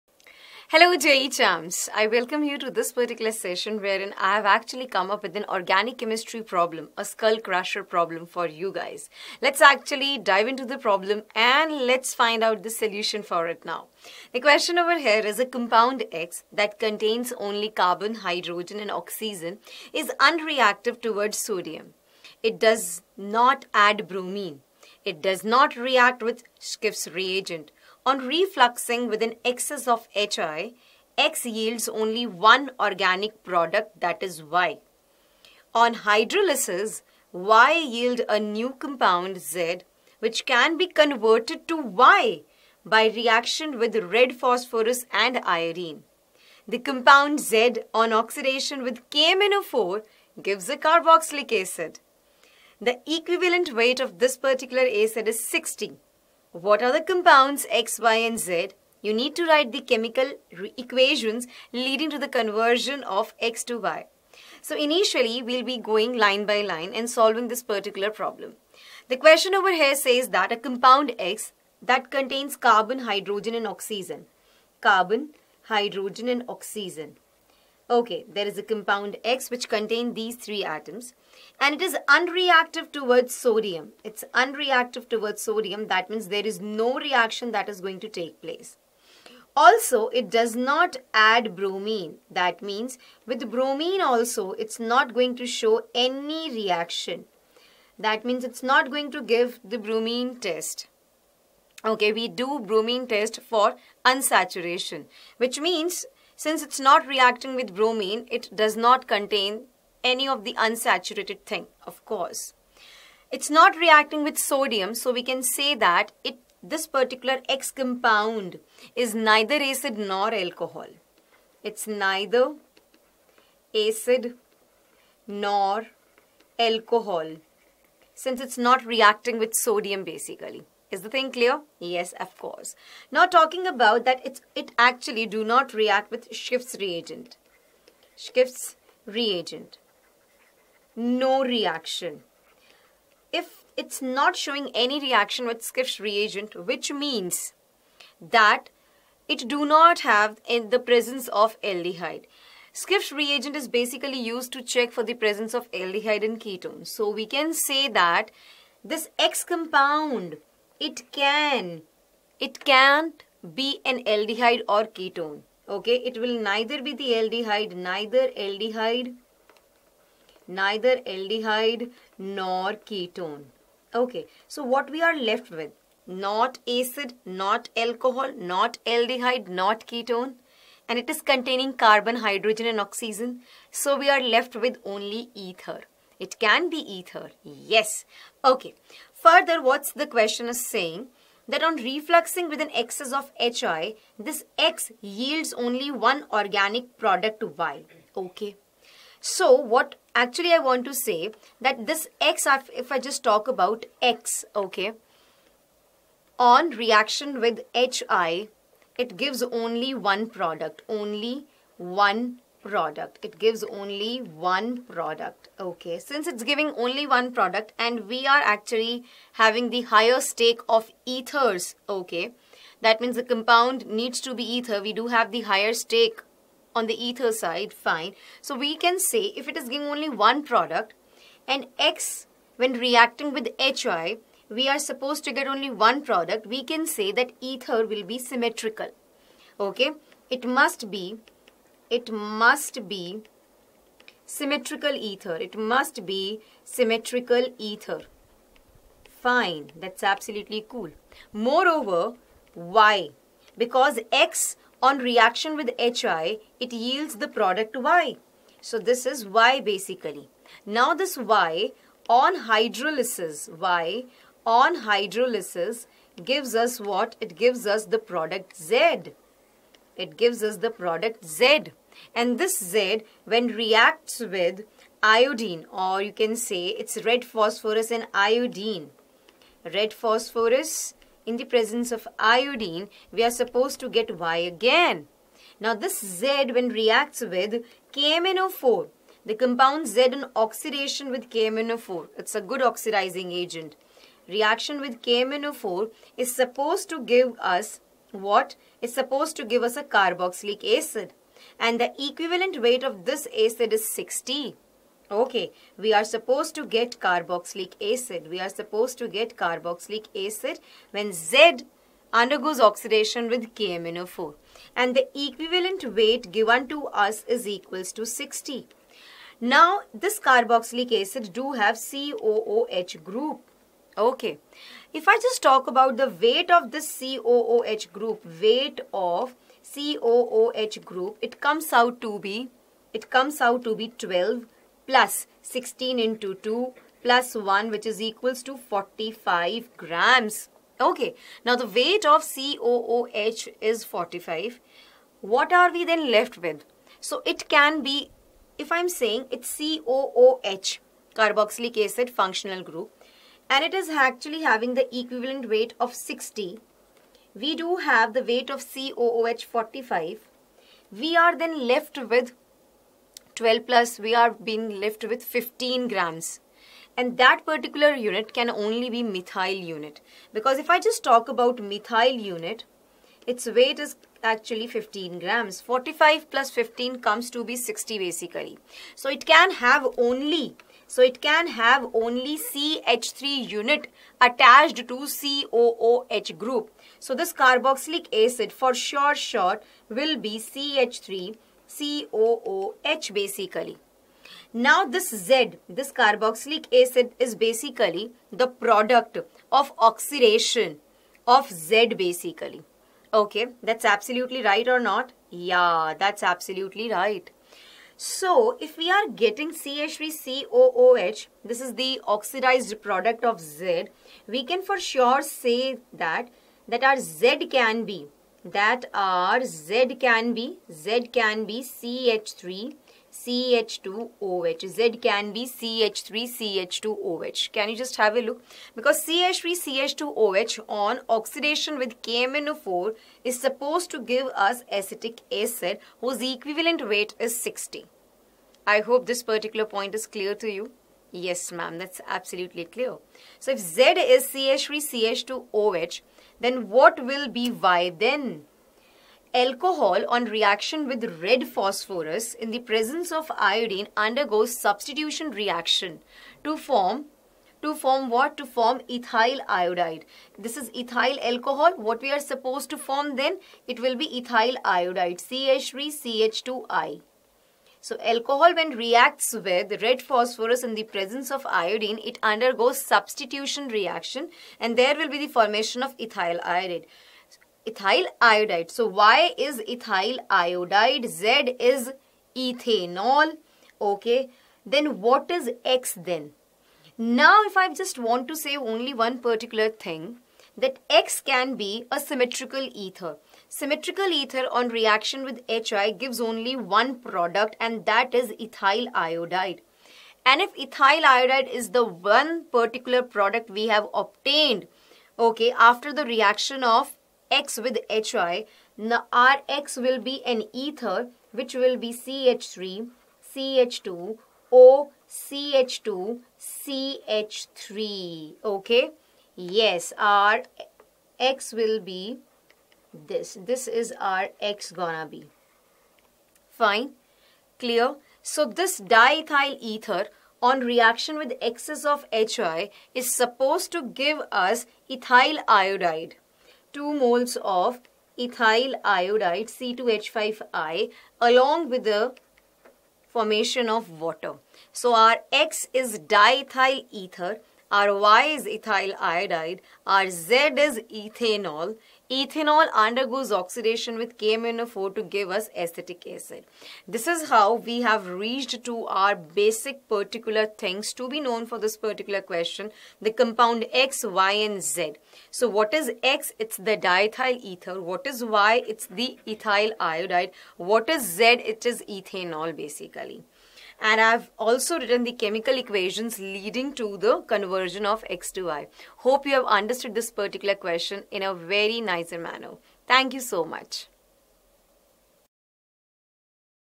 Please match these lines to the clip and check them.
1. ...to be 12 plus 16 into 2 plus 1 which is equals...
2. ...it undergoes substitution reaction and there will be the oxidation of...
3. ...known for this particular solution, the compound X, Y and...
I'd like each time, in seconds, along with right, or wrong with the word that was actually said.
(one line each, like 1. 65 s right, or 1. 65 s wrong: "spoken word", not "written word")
1. 333 s right
2. 472 s wrong: "formation", not "oxidation"
3. 561 s wrong: "question", not "solution".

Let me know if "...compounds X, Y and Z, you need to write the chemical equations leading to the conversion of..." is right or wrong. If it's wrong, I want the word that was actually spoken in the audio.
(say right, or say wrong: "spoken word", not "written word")
right.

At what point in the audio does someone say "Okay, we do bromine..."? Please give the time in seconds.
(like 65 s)
101 s.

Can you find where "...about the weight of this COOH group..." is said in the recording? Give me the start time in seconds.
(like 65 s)
325 s.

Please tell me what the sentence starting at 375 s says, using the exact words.
45 plus 15 comes to be 60 basically.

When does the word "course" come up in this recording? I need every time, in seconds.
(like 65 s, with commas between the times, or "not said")
112 s, 132 s.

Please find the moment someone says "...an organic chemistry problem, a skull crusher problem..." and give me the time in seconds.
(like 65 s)
5 s.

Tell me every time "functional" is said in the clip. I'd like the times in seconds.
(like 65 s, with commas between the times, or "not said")
352 s.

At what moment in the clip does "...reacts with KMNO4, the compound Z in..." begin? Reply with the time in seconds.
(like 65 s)
286 s.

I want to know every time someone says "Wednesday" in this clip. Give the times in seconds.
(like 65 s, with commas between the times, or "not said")
not said.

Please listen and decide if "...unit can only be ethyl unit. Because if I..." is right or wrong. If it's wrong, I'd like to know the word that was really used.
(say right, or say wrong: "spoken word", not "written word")
wrong: "methyl", not "ethyl".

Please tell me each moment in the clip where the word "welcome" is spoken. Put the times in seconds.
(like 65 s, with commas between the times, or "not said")
2 s.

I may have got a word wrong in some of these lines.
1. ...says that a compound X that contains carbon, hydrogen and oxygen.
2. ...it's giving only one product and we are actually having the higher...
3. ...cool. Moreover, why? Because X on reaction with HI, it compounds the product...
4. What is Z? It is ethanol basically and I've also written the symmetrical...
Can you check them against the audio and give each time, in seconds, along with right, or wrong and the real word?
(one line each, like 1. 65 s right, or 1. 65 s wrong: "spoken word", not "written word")
1. 69 s right
2. 216 s right
3. 250 s wrong: "yields", not "compounds"
4. 570 s wrong: "chemical", not "symmetrical".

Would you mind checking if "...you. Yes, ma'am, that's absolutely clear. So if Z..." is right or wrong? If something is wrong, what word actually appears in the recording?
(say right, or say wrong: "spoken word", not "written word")
right.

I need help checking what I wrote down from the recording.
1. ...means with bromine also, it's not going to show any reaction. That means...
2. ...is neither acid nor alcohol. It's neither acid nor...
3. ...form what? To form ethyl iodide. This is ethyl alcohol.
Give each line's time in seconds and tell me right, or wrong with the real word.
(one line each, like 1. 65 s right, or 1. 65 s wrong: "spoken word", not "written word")
1. 92 s right
2. 118 s right
3. 457 s right.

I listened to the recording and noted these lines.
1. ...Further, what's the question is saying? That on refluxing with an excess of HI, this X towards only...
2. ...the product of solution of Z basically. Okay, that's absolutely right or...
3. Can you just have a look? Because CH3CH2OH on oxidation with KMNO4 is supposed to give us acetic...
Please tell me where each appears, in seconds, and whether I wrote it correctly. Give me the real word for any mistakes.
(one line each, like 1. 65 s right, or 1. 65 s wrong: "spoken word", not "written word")
1. 189 s wrong: "yields", not "towards"
2. 398 s wrong: "oxidation", not "solution"
3. 427 s right.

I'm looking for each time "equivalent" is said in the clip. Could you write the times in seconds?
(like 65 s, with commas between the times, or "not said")
53 s, 301 s, 315 s, 354 s, 436 s.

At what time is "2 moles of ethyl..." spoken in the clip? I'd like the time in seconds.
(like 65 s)
536 s.